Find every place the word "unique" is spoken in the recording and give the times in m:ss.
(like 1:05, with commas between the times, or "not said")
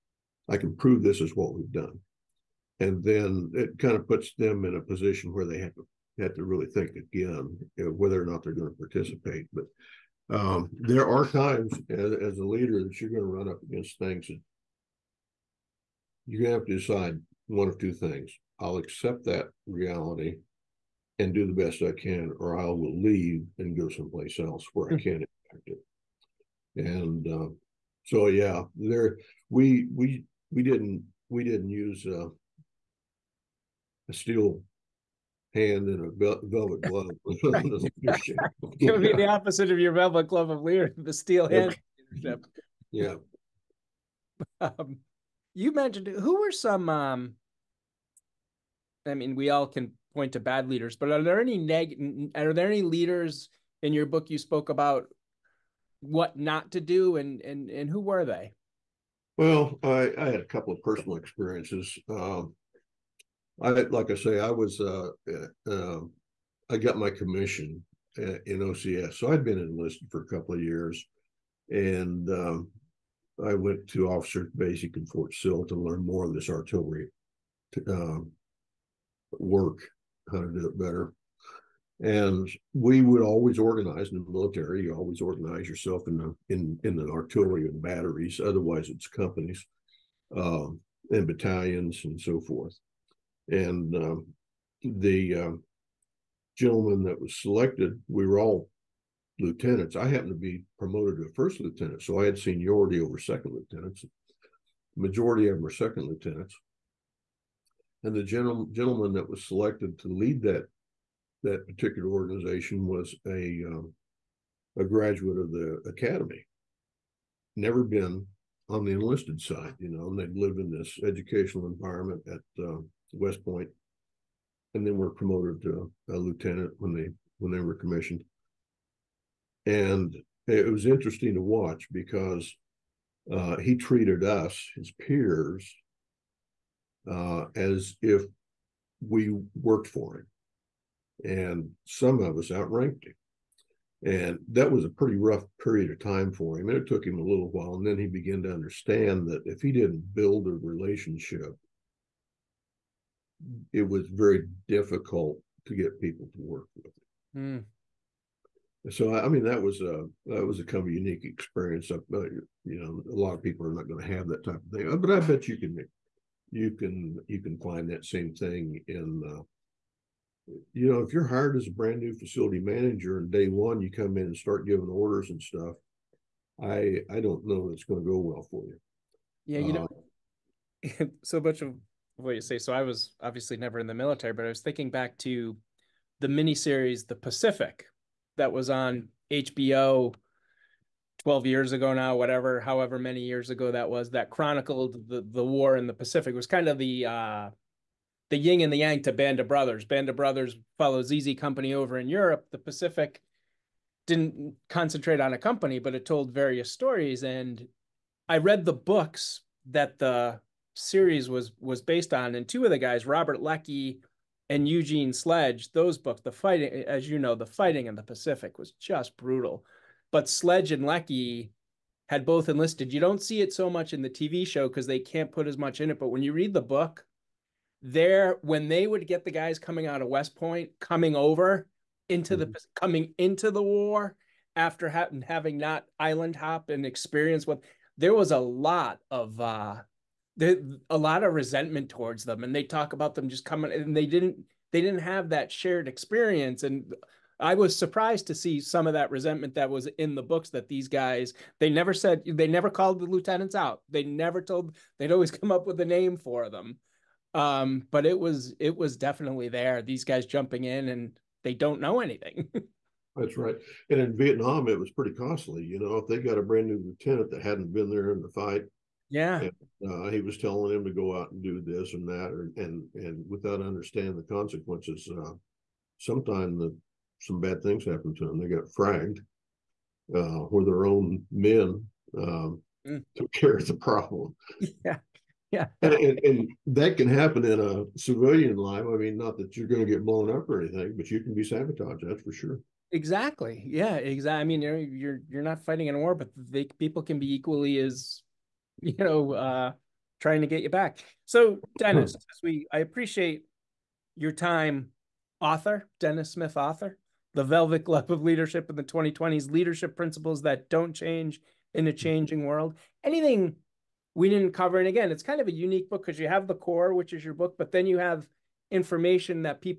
2:40, 5:15.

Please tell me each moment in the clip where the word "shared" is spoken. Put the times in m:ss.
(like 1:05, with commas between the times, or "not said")
4:05.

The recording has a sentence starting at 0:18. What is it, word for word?
I'll accept that reality and do the best I can, or I will leave and go someplace else where I hmm.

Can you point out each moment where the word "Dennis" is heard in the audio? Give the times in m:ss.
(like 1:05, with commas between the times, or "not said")
5:01, 5:05.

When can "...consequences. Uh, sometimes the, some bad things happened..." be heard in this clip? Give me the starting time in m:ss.
4:34.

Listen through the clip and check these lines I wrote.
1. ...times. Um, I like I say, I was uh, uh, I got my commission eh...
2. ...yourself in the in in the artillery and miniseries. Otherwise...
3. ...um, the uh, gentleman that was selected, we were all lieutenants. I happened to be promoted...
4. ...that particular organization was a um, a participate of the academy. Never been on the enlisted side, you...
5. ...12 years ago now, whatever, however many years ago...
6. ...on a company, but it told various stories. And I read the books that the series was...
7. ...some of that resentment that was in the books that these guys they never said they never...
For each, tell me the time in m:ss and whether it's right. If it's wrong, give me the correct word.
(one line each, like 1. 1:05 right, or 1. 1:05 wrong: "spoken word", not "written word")
1. 1:01 wrong: "experiences", not "times"
2. 1:25 wrong: "batteries", not "miniseries"
3. 1:33 right
4. 1:51 wrong: "graduate", not "participate"
5. 3:11 right
6. 3:25 right
7. 4:08 right.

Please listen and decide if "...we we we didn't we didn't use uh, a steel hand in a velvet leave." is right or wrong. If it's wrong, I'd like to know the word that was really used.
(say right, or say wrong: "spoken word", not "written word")
wrong: "glove", not "leave".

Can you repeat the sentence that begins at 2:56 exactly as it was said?
I I don't know it's going to go well for you.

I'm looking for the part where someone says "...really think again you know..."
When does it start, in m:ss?
0:06.